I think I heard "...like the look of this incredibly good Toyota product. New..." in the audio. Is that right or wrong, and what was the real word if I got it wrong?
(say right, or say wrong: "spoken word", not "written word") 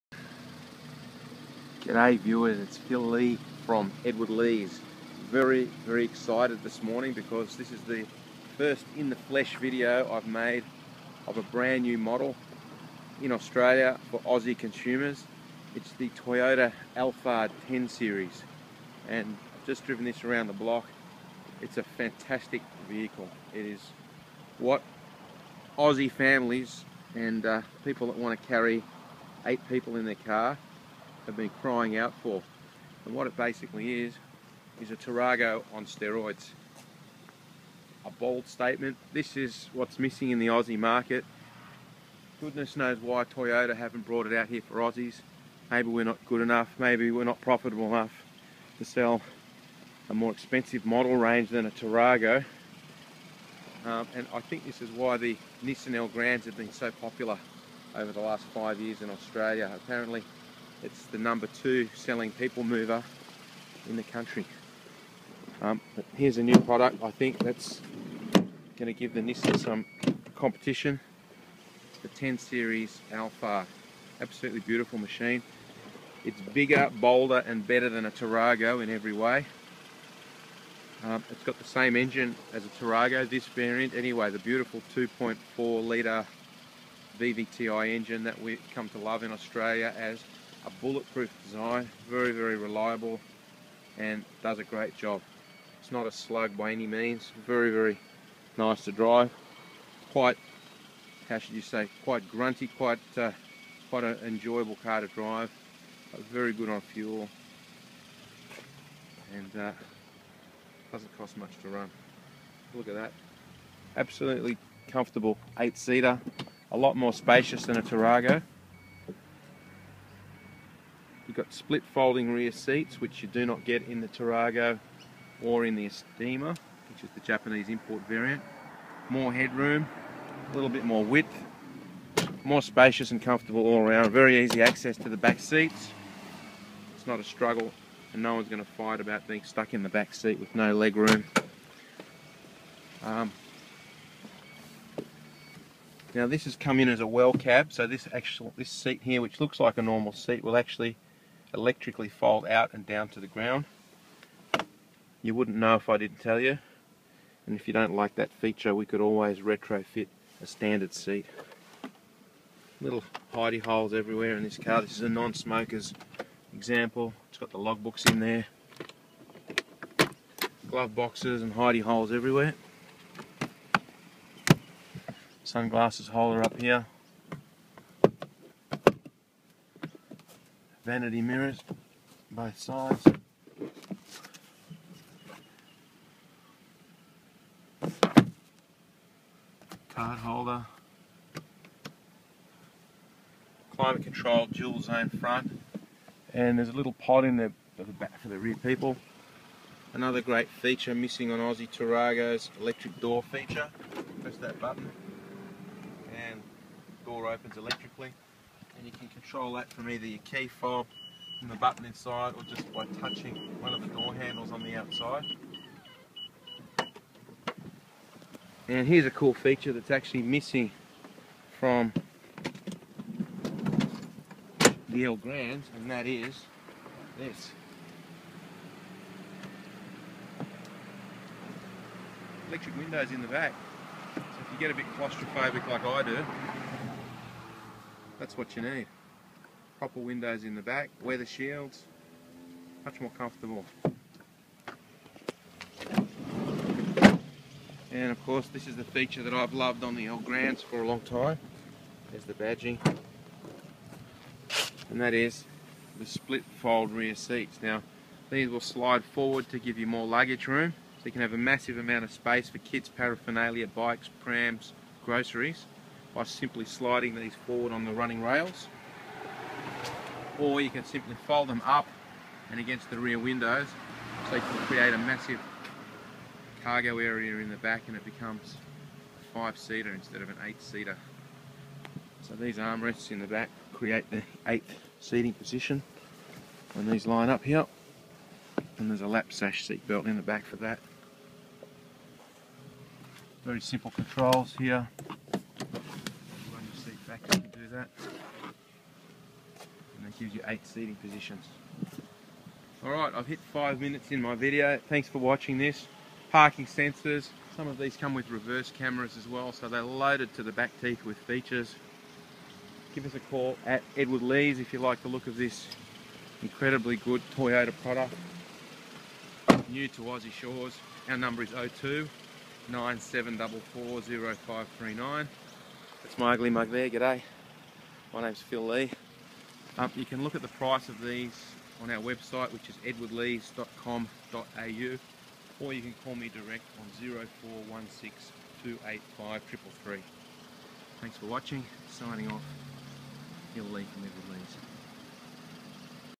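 right.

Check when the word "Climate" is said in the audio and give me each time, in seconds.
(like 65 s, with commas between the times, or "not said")
193 s.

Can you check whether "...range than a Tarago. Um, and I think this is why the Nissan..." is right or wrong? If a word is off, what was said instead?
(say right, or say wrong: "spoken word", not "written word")
right.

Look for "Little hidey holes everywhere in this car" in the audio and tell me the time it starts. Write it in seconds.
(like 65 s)
162 s.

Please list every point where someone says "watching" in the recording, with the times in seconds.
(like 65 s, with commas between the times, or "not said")
305 s, 341 s.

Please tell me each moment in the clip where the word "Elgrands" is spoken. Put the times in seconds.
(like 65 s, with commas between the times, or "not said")
55 s, 225 s, 250 s.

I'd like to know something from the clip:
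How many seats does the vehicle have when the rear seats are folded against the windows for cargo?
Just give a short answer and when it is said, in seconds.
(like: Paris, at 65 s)
5, at 279 s.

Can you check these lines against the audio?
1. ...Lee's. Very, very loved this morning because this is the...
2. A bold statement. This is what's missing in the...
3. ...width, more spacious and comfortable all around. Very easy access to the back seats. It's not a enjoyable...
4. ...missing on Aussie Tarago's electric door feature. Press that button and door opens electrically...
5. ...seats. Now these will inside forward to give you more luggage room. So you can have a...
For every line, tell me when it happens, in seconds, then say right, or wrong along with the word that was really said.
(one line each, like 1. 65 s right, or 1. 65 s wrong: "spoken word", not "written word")
1. 4 s wrong: "excited", not "loved"
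2. 38 s right
3. 131 s wrong: "struggle", not "enjoyable"
4. 200 s right
5. 257 s wrong: "slide", not "inside".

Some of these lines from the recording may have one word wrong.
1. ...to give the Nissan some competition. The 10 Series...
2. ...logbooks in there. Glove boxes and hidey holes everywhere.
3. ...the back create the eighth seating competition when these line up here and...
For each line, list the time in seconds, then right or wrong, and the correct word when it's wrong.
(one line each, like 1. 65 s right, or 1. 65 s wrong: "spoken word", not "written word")
1. 68 s right
2. 167 s right
3. 283 s wrong: "position", not "competition".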